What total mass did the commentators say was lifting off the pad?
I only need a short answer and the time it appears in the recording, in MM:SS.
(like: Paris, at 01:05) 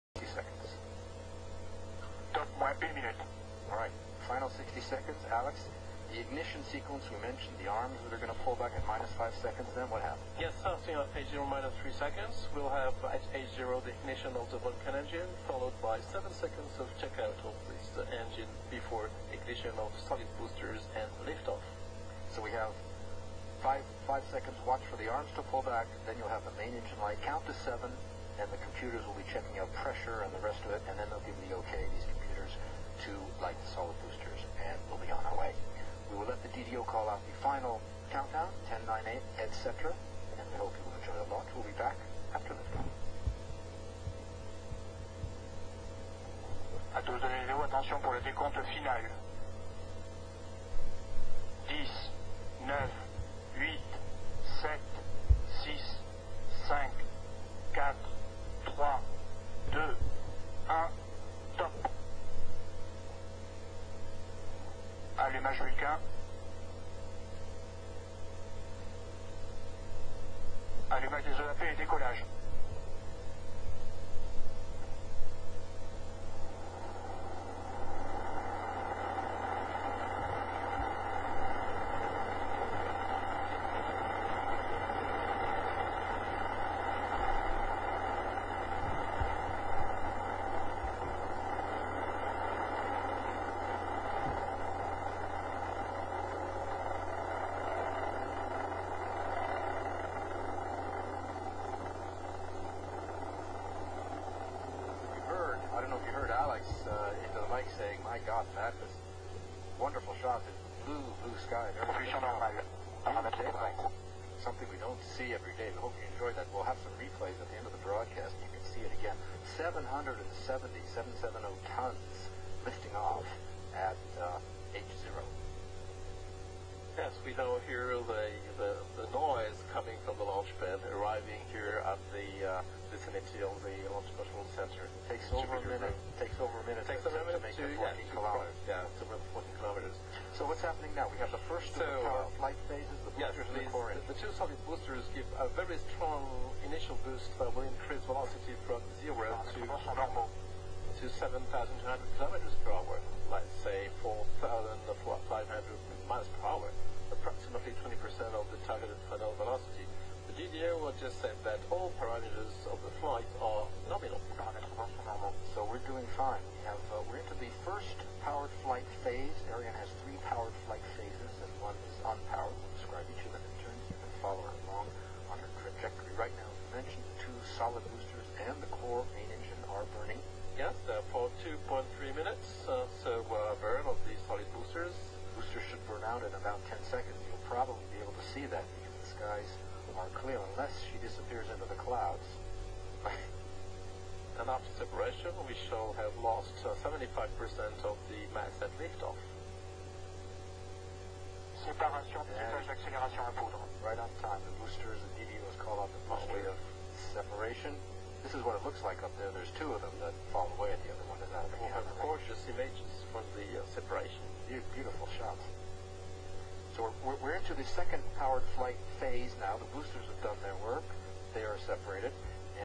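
770 tons, at 02:00.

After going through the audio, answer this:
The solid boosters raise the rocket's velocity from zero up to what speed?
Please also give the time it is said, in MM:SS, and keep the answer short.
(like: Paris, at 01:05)
7,200 km/h, at 02:31.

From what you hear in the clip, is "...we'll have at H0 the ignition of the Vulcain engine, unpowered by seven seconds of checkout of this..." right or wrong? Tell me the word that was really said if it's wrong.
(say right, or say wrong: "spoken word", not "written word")
wrong: "followed", not "unpowered".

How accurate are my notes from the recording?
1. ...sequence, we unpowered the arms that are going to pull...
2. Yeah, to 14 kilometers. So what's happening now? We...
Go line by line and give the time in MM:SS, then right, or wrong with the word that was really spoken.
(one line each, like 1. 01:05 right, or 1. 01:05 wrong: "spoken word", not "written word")
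1. 00:06 wrong: "mentioned", not "unpowered"
2. 02:18 right.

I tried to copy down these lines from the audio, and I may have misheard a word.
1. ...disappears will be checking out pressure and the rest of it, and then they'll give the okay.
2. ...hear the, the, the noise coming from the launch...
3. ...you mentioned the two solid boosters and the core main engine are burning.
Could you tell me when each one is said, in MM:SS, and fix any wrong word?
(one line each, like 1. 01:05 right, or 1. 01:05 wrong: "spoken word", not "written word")
1. 00:28 wrong: "computers", not "disappears"
2. 02:07 right
3. 02:56 right.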